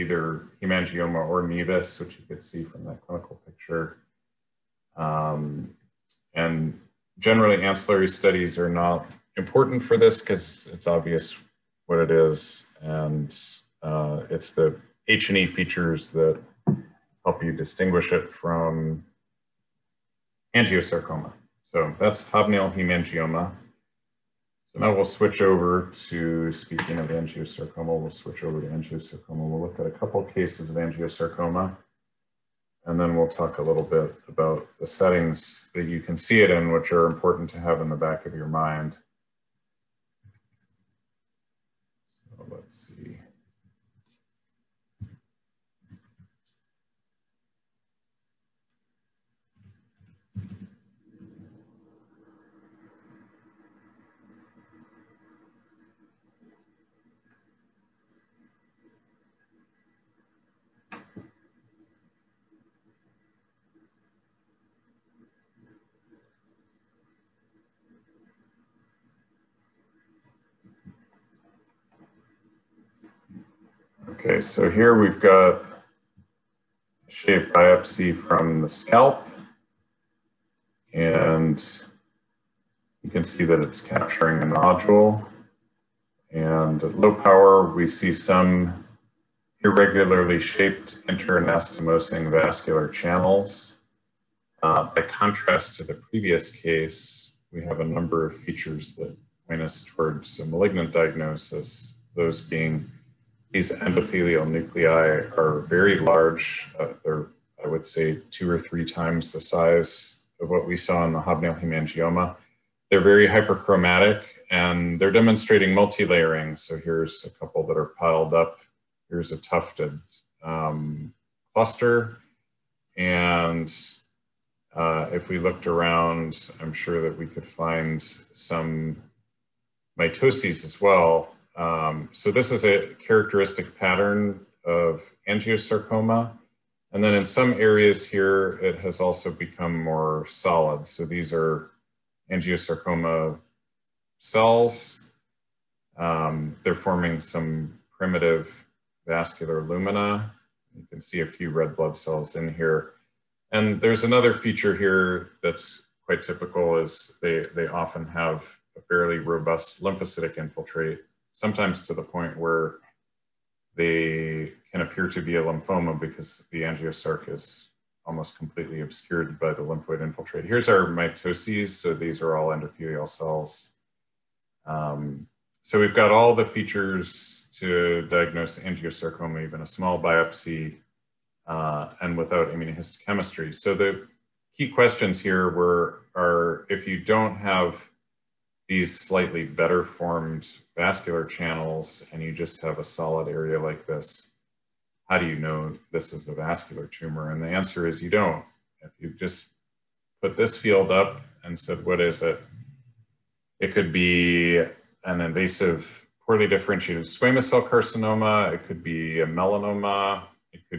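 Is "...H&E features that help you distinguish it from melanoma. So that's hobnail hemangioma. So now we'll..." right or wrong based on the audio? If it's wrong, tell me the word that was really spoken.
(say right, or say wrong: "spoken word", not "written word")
wrong: "angiosarcoma", not "melanoma".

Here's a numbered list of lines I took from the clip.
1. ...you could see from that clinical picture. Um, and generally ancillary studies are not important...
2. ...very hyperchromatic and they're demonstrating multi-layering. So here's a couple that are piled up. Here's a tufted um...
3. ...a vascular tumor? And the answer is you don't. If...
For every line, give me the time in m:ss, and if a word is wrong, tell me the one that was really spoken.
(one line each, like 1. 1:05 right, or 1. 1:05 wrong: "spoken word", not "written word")
1. 0:02 right
2. 1:53 right
3. 3:16 right.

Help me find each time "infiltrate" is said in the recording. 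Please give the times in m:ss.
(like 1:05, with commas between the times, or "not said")
2:40, 2:50.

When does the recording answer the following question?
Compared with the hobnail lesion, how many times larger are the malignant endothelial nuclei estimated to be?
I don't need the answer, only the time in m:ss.
1:48.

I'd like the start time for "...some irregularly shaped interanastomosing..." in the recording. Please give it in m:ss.
1:28.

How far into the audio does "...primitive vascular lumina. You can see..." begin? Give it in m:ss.
2:27.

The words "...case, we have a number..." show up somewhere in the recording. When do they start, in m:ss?
1:36.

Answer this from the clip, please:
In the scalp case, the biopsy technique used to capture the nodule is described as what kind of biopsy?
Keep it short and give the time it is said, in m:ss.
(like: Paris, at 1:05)
Shave biopsy, at 1:17.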